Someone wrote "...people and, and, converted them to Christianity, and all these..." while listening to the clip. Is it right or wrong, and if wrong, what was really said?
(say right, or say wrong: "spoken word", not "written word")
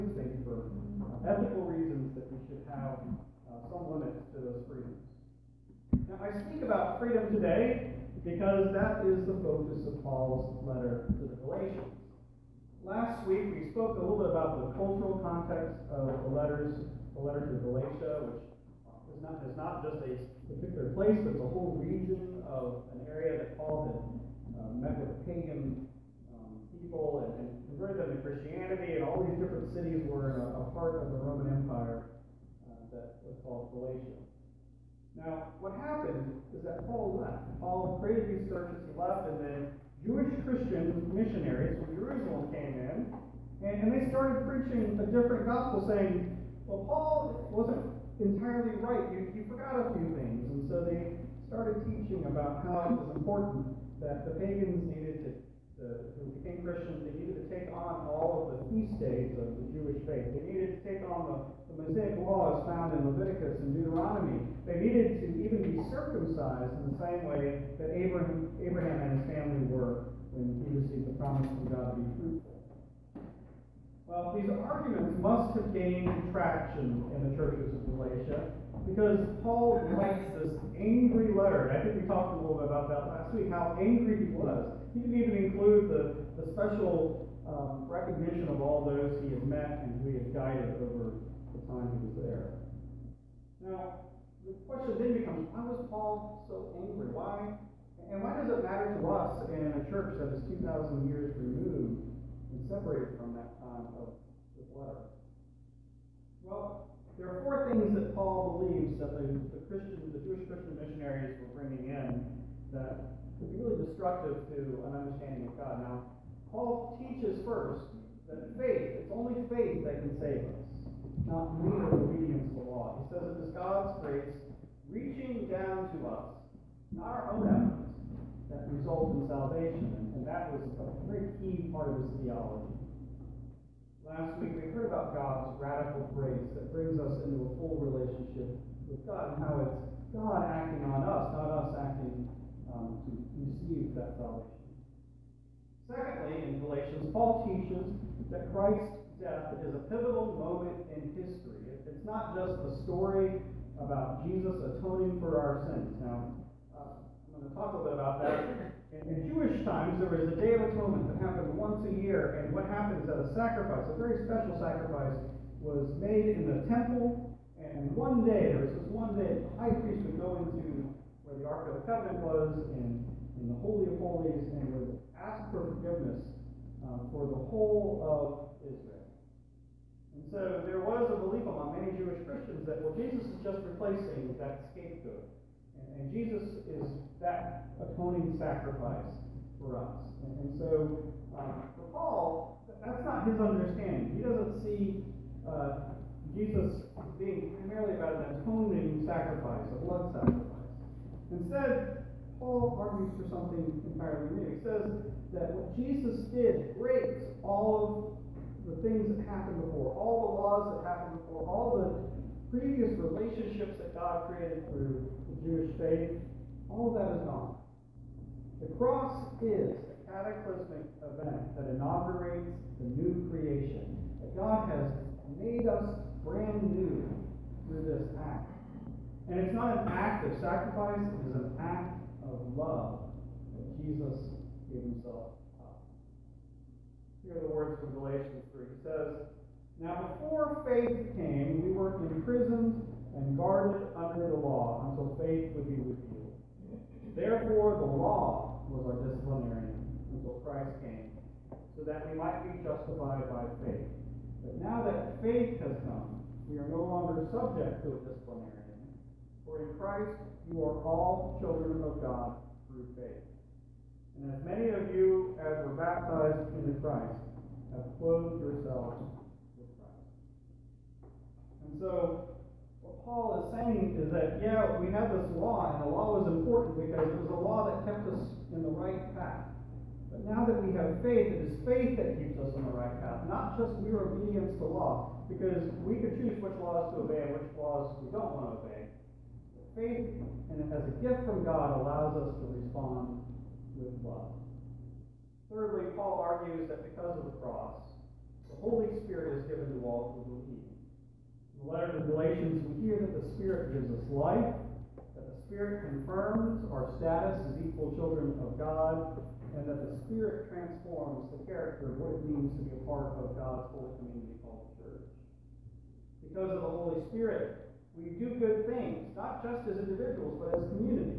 right.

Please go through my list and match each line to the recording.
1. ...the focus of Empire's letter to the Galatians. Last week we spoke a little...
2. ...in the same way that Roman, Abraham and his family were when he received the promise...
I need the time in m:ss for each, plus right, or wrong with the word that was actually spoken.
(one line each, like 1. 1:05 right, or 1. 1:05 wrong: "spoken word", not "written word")
1. 0:09 wrong: "Paul", not "Empire"
2. 1:06 wrong: "Abraham", not "Roman".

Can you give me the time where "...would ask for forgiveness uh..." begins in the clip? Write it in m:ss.
2:54.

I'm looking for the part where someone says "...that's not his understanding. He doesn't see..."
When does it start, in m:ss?
3:12.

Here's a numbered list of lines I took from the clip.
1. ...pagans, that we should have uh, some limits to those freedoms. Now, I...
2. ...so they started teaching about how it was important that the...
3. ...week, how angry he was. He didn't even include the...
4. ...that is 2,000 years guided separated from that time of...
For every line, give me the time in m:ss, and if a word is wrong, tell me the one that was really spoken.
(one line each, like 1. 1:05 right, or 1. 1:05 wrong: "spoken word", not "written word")
1. 0:01 wrong: "reasons", not "pagans"
2. 0:50 right
3. 1:23 right
4. 1:40 wrong: "removed", not "guided".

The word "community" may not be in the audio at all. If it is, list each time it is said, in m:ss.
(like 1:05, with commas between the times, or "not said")
5:14.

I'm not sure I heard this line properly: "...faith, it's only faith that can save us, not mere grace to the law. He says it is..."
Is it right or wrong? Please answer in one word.
wrong.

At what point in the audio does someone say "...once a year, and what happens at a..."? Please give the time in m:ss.
2:41.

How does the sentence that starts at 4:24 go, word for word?
And as many of you as were baptized into Christ have clothed yourselves with Christ.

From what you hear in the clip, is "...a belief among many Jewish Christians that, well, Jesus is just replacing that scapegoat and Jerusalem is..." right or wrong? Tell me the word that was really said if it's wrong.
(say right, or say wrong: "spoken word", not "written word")
wrong: "Jesus", not "Jerusalem".